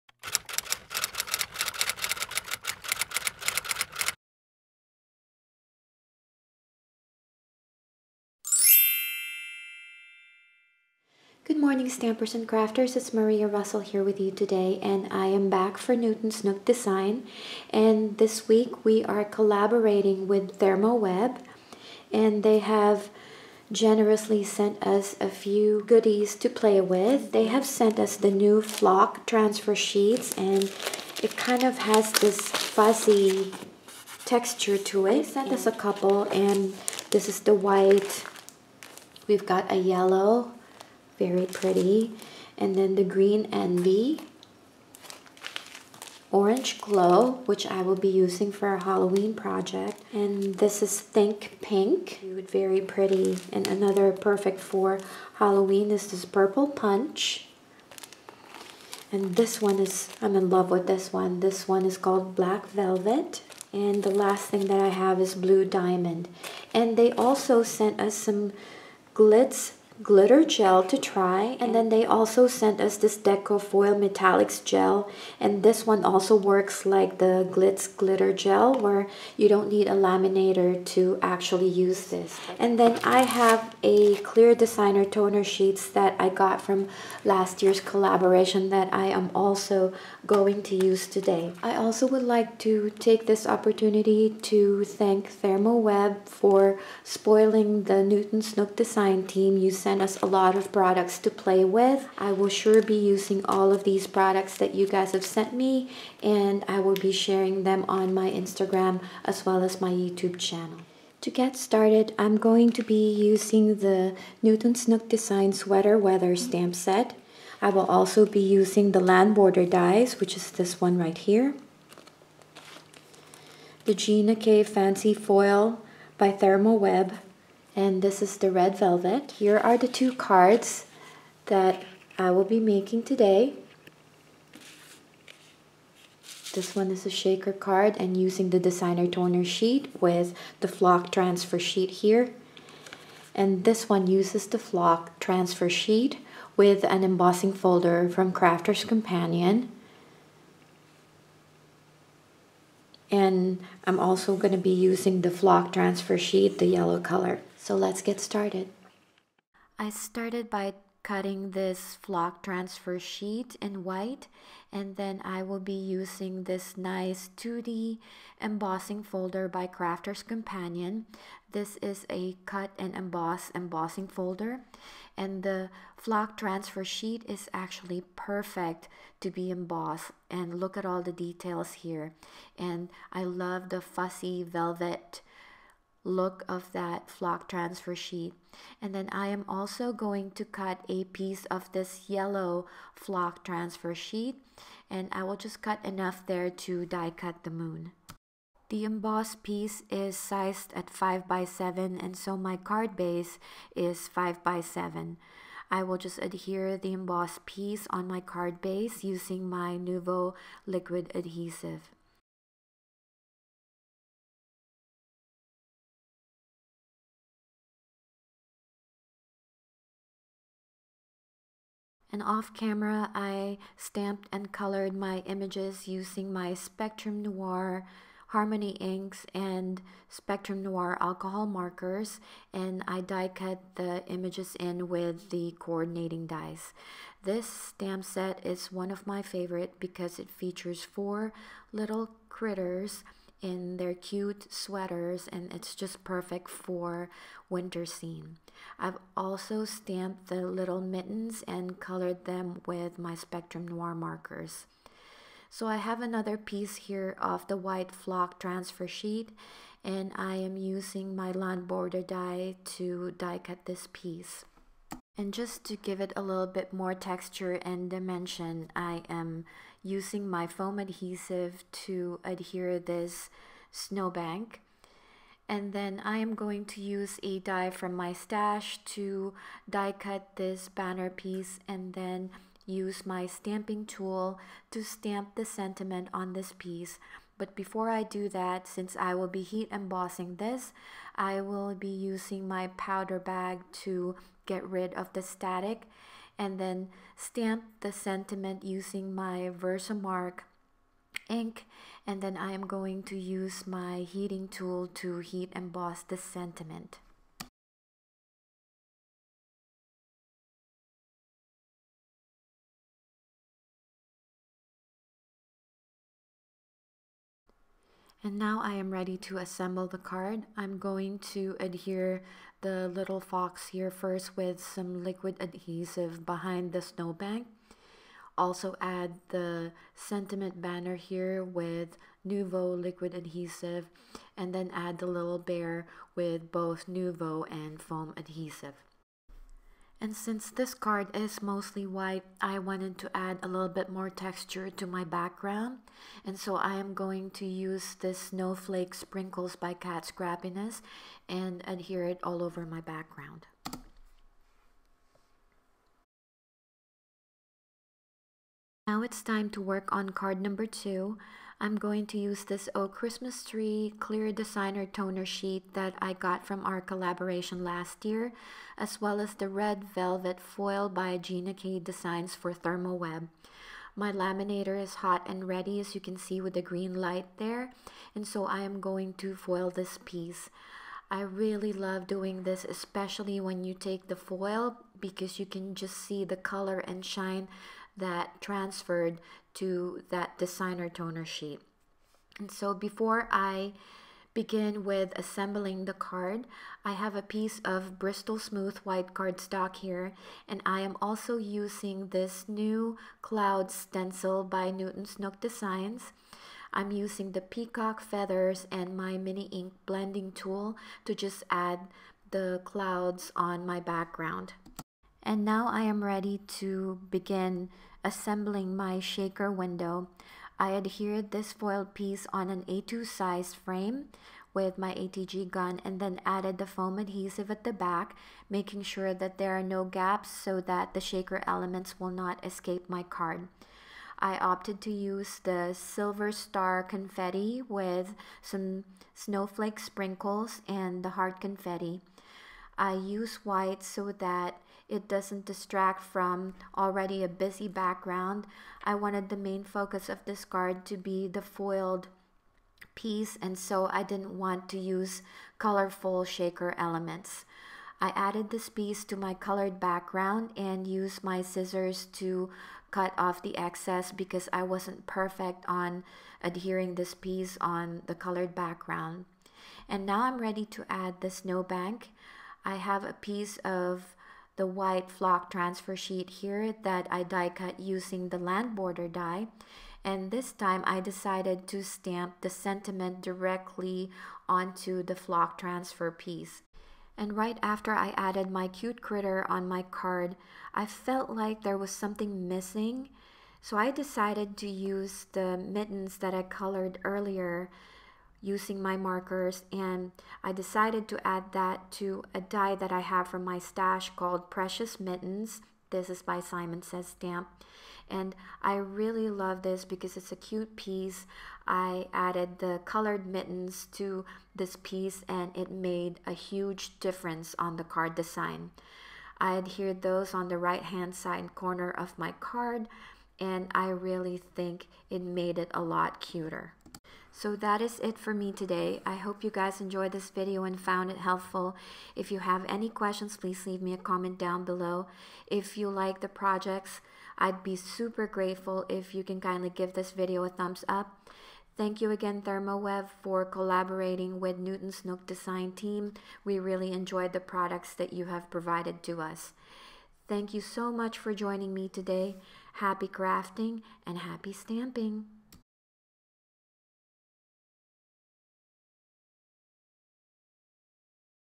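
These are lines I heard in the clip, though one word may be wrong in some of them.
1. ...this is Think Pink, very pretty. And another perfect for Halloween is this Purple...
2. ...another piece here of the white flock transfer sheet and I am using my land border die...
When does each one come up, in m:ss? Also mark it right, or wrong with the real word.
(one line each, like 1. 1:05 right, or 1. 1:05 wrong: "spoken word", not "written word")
1. 0:50 right
2. 4:16 right.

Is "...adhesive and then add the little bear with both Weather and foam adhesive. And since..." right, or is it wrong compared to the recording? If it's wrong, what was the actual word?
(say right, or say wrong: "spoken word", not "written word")
wrong: "Nuvo", not "Weather".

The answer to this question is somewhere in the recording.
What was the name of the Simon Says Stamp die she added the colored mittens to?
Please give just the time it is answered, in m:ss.
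8:24.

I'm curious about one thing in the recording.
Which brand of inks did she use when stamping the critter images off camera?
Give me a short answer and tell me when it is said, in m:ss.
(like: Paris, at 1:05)
Spectrum Noir Harmony, at 3:46.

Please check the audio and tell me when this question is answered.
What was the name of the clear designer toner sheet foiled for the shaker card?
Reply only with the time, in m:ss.
6:02.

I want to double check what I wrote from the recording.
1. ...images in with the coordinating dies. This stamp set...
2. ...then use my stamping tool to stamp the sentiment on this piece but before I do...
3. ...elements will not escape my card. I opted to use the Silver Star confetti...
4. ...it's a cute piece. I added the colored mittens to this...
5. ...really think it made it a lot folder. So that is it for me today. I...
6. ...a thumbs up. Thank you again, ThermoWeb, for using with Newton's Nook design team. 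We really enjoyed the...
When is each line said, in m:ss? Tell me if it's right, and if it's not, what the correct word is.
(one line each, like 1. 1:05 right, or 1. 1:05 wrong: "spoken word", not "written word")
1. 3:54 right
2. 4:41 right
3. 7:11 right
4. 8:30 right
5. 8:43 wrong: "cuter", not "folder"
6. 9:00 wrong: "collaborating", not "using".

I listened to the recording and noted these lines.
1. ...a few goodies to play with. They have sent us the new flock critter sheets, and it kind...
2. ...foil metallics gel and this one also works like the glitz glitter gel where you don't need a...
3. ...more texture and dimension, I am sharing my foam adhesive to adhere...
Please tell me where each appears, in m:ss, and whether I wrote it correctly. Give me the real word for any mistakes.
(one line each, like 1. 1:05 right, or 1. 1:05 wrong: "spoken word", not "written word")
1. 0:25 wrong: "transfer", not "critter"
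2. 1:13 right
3. 4:26 wrong: "using", not "sharing".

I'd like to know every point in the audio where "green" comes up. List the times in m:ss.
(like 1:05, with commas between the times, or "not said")
0:43, 6:16.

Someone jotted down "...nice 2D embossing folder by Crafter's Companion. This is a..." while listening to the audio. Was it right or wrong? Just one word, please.
right.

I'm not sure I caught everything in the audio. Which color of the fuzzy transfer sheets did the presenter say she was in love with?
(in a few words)
Black Velvet.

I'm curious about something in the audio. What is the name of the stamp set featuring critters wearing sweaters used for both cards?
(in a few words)
Sweater Weather.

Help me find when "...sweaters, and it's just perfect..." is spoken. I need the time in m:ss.
4:04.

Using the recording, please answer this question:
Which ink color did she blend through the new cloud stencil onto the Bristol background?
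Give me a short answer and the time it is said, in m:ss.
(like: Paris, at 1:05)
peacock feathers, at 6:47.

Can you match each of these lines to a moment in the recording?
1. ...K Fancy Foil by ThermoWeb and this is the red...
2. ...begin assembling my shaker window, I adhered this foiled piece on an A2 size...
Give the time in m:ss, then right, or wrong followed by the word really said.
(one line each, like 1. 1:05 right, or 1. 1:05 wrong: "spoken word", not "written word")
1. 2:04 right
2. 6:57 right.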